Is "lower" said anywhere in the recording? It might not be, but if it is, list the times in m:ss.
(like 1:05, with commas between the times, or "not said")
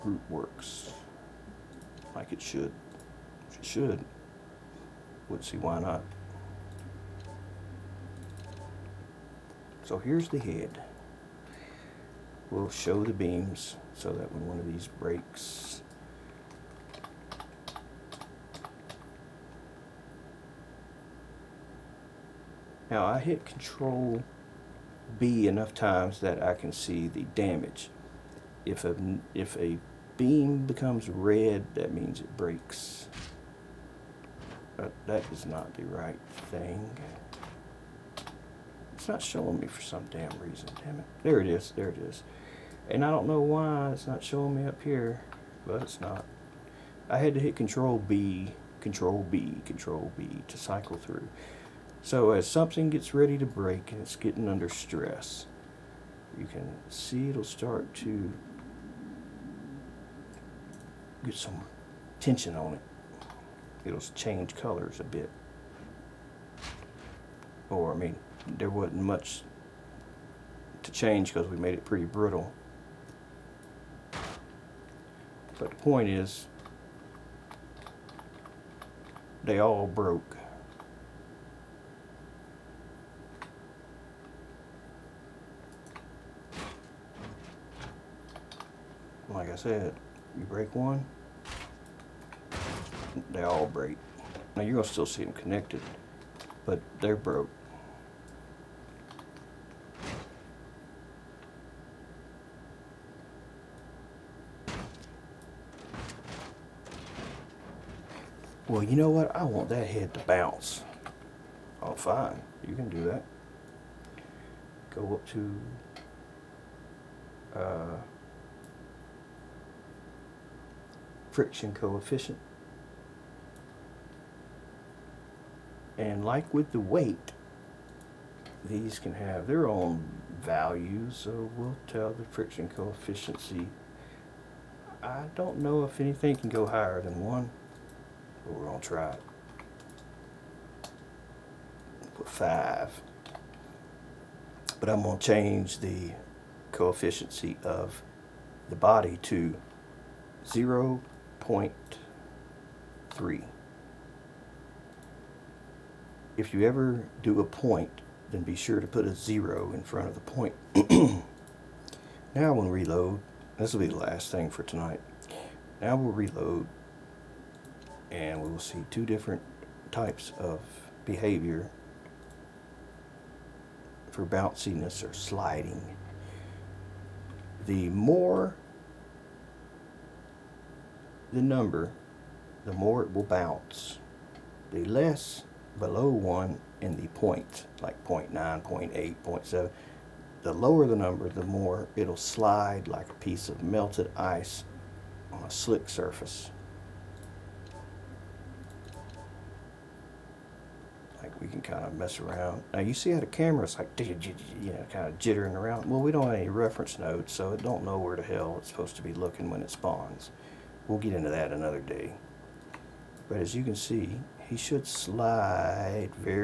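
3:10.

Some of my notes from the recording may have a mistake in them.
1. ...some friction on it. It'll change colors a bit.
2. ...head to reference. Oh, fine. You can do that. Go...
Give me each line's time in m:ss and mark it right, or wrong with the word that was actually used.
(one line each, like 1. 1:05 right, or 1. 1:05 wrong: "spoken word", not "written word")
1. 1:01 wrong: "tension", not "friction"
2. 1:49 wrong: "bounce", not "reference".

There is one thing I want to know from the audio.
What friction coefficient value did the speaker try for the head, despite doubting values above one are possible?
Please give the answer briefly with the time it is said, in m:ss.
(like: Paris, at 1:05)
5, at 2:22.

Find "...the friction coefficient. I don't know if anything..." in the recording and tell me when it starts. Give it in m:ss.
2:12.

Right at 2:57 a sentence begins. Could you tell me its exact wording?
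The more the number, the more it will bounce.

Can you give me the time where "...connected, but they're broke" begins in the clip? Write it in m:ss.
1:35.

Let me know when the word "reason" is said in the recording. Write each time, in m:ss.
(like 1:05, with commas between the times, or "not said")
0:40.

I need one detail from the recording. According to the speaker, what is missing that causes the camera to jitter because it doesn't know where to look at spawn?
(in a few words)
Reference nodes.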